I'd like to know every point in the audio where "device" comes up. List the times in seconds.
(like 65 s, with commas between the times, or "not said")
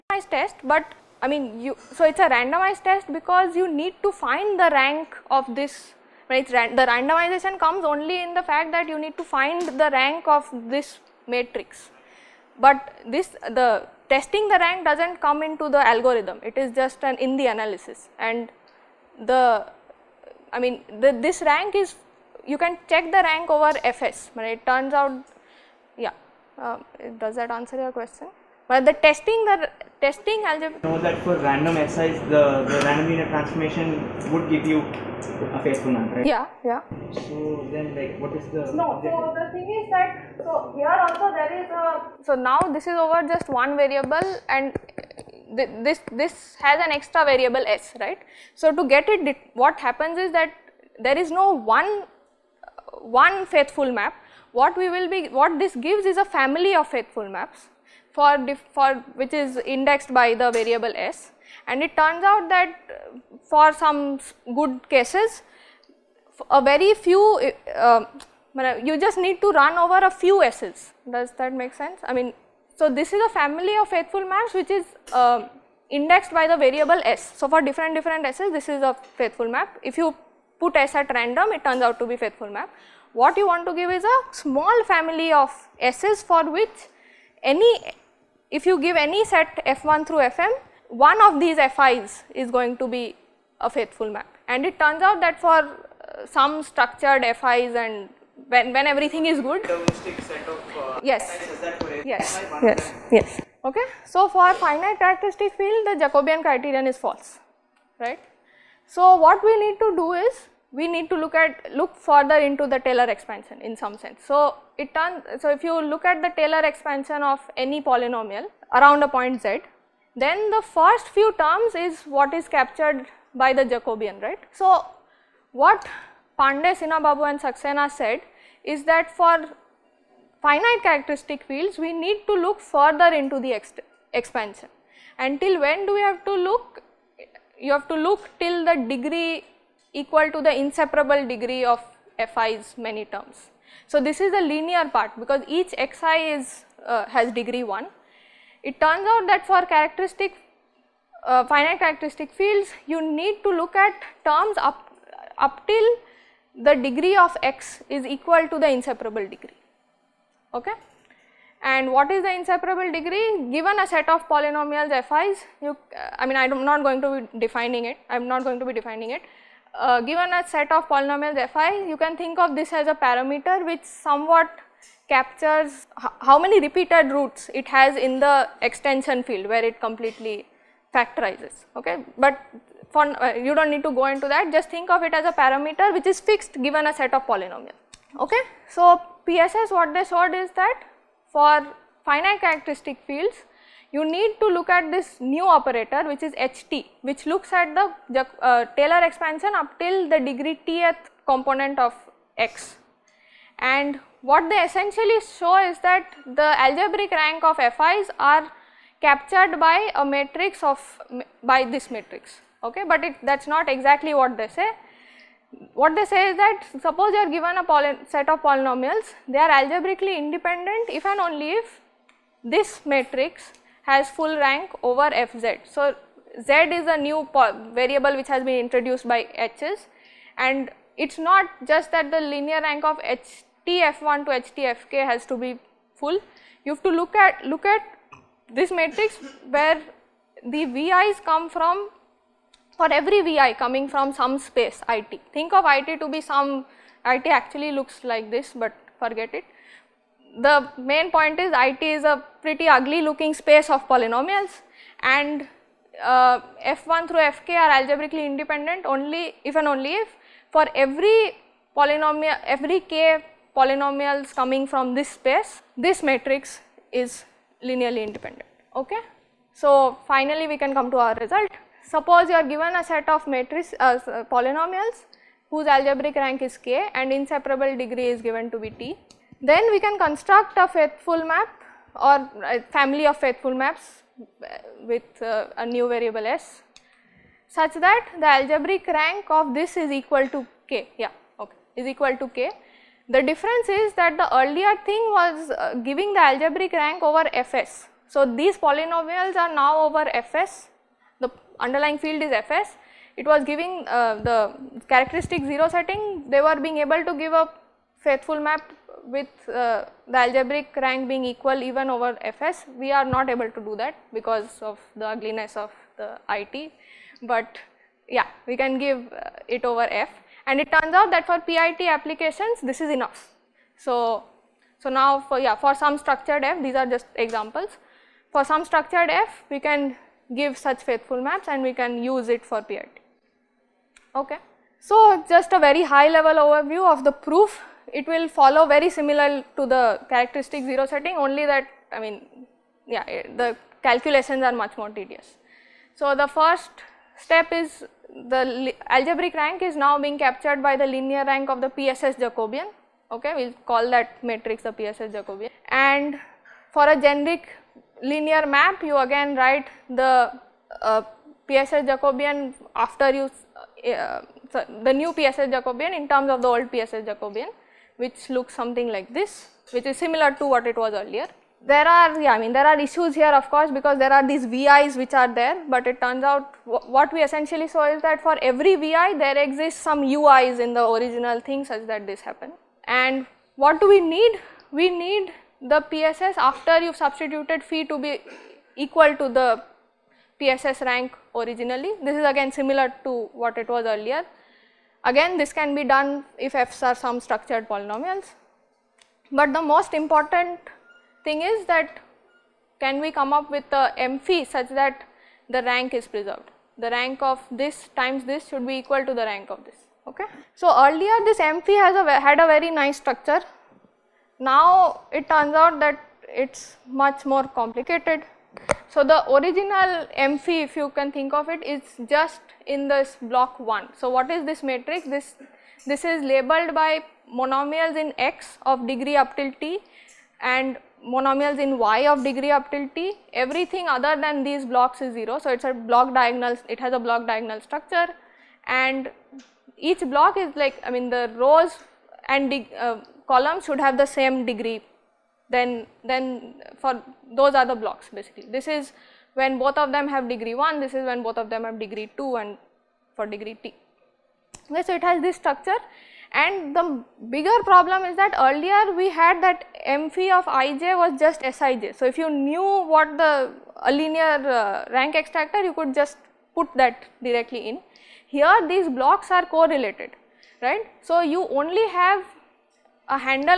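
not said.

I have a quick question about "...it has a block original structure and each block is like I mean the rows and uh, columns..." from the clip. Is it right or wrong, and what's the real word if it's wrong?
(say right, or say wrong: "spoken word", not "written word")
wrong: "diagonal", not "original".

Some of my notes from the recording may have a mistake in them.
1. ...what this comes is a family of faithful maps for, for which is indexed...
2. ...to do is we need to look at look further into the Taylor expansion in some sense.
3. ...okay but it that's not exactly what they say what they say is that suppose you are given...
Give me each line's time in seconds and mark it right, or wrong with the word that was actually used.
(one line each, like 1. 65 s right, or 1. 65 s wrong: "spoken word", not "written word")
1. 55 s wrong: "gives", not "comes"
2. 109 s right
3. 212 s right.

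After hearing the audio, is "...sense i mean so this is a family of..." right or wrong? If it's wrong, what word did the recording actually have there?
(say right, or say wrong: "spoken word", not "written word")
right.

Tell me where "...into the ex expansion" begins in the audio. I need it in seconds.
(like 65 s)
133 s.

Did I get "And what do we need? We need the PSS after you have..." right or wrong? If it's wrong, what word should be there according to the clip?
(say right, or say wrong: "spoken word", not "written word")
right.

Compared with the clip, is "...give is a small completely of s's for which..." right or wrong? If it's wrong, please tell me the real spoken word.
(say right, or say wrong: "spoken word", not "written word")
wrong: "family", not "completely".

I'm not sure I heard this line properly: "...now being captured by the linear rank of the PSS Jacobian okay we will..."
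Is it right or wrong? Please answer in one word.
right.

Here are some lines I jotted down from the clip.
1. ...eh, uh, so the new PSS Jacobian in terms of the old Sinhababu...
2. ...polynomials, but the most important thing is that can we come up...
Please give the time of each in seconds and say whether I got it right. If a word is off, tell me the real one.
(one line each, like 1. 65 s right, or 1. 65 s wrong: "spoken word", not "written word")
1. 363 s wrong: "PSS", not "Sinhababu"
2. 397 s right.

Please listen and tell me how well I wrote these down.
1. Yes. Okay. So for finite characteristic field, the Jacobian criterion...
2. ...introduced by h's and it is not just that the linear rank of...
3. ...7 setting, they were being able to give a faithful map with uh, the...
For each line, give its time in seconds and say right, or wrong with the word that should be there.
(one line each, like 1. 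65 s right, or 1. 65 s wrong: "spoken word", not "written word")
1. 103 s right
2. 228 s right
3. 305 s wrong: "0", not "7".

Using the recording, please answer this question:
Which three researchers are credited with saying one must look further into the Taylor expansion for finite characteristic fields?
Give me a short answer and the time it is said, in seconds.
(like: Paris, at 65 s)
Pandey, Sinhababu and Saxena, at 126 s.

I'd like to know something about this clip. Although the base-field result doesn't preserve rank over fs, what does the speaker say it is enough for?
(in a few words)
PIT applications.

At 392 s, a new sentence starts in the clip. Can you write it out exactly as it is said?
This is again similar to what it was earlier.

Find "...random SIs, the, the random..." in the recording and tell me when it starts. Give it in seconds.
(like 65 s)
31 s.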